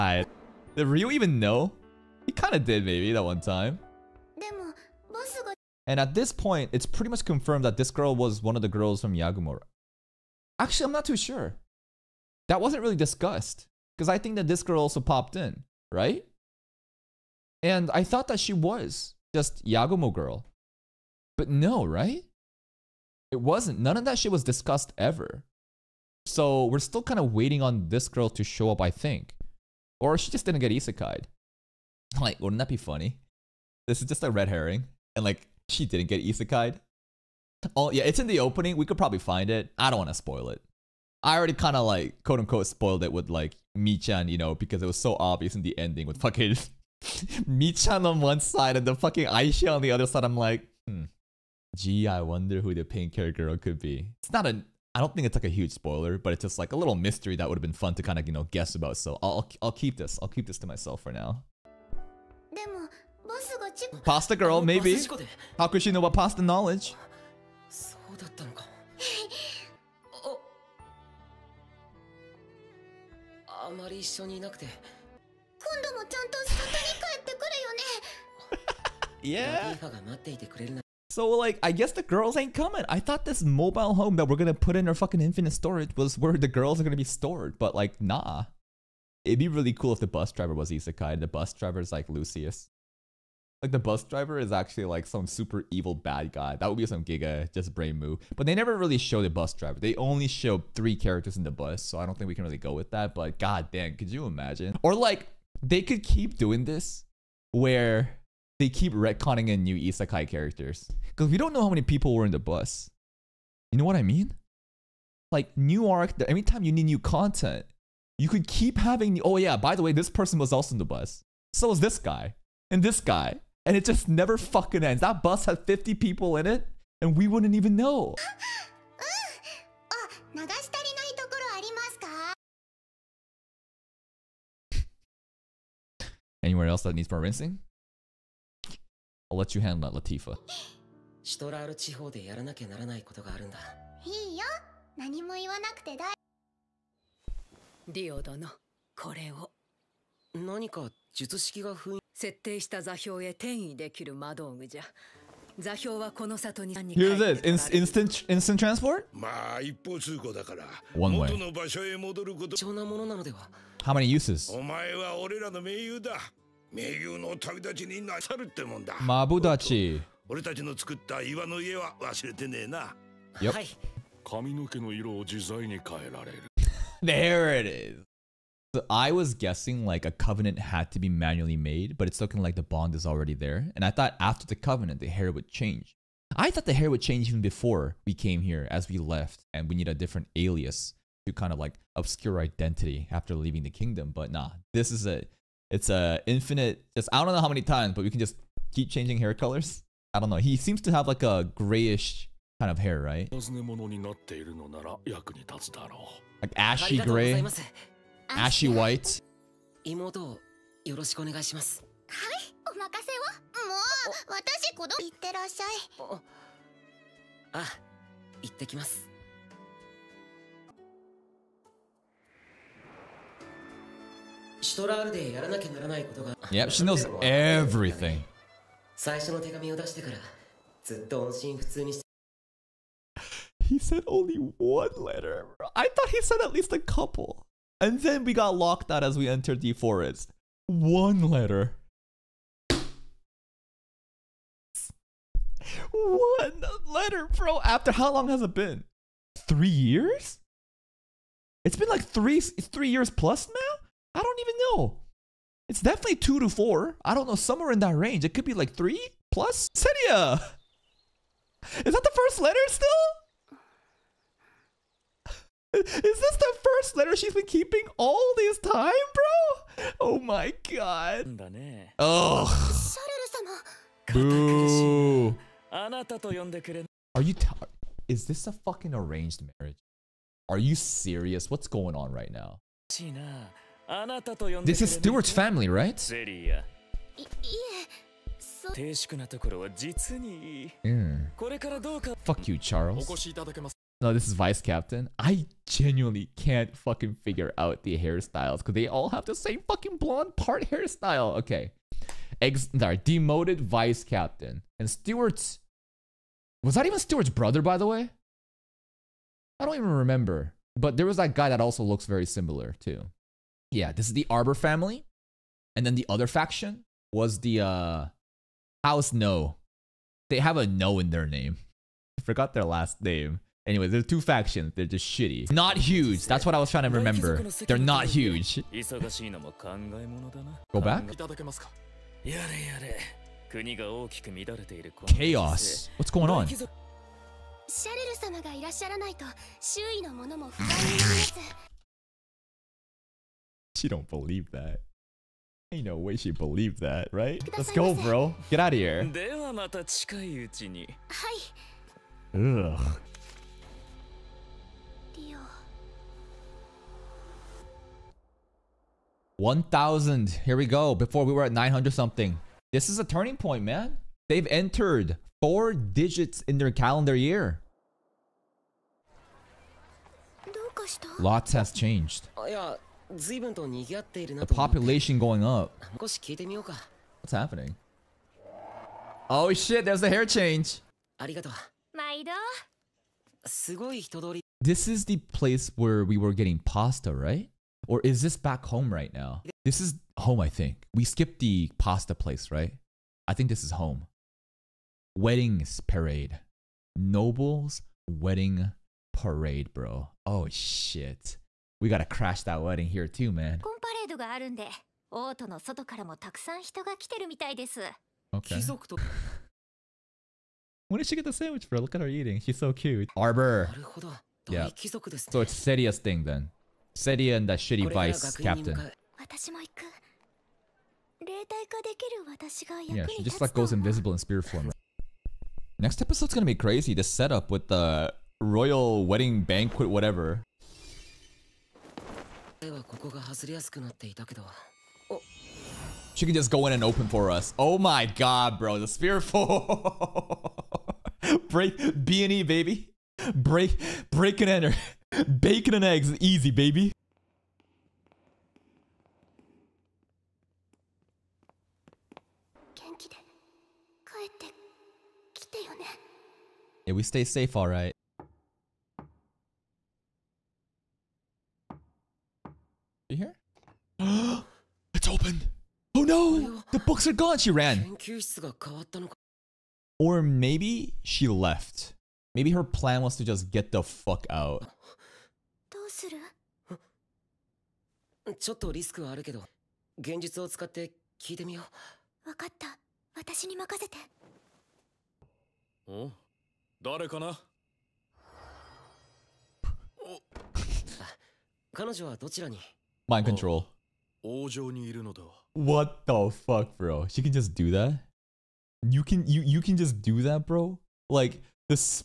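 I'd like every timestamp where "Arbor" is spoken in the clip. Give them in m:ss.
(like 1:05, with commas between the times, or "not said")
5:14, 6:53.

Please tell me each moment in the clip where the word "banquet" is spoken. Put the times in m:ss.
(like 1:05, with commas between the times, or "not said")
7:09.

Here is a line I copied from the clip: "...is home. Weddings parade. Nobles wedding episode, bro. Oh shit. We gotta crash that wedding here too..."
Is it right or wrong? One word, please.
wrong.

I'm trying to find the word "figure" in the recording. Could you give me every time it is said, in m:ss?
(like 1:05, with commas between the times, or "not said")
4:57.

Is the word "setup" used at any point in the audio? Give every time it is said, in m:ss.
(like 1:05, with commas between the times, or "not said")
7:07.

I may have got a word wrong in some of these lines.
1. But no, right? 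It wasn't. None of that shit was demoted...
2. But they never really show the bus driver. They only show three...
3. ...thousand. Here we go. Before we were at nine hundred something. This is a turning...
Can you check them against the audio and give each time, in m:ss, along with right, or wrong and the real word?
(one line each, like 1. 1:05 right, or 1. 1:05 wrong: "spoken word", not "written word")
1. 0:21 wrong: "discussed", not "demoted"
2. 1:38 right
3. 5:59 right.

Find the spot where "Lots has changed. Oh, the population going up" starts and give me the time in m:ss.
6:11.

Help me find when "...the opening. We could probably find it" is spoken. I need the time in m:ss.
0:38.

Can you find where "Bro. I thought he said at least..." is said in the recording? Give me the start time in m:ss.
3:55.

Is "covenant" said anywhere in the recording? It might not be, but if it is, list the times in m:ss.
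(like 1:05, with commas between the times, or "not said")
3:00, 3:04.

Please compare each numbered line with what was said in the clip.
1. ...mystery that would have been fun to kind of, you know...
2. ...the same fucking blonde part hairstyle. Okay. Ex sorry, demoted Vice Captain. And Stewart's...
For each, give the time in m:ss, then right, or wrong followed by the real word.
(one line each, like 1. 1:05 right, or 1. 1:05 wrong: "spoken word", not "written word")
1. 0:56 right
2. 4:59 right.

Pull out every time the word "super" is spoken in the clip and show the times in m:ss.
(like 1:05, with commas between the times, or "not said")
1:35.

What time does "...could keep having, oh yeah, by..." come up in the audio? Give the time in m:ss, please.
1:58.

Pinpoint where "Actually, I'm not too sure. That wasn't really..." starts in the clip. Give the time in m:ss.
0:10.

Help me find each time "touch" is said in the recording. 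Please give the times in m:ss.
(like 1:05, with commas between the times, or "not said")
not said.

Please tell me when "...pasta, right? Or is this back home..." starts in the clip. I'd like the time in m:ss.
6:26.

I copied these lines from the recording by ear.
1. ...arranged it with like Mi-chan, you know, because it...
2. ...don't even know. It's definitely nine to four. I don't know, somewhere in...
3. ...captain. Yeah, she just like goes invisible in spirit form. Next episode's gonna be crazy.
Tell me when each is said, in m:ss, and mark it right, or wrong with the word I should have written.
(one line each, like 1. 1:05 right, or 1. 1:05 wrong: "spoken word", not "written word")
1. 0:42 wrong: "spoiled", not "arranged"
2. 4:14 wrong: "two", not "nine"
3. 6:58 right.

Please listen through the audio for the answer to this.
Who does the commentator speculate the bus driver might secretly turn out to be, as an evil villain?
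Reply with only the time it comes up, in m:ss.
1:32.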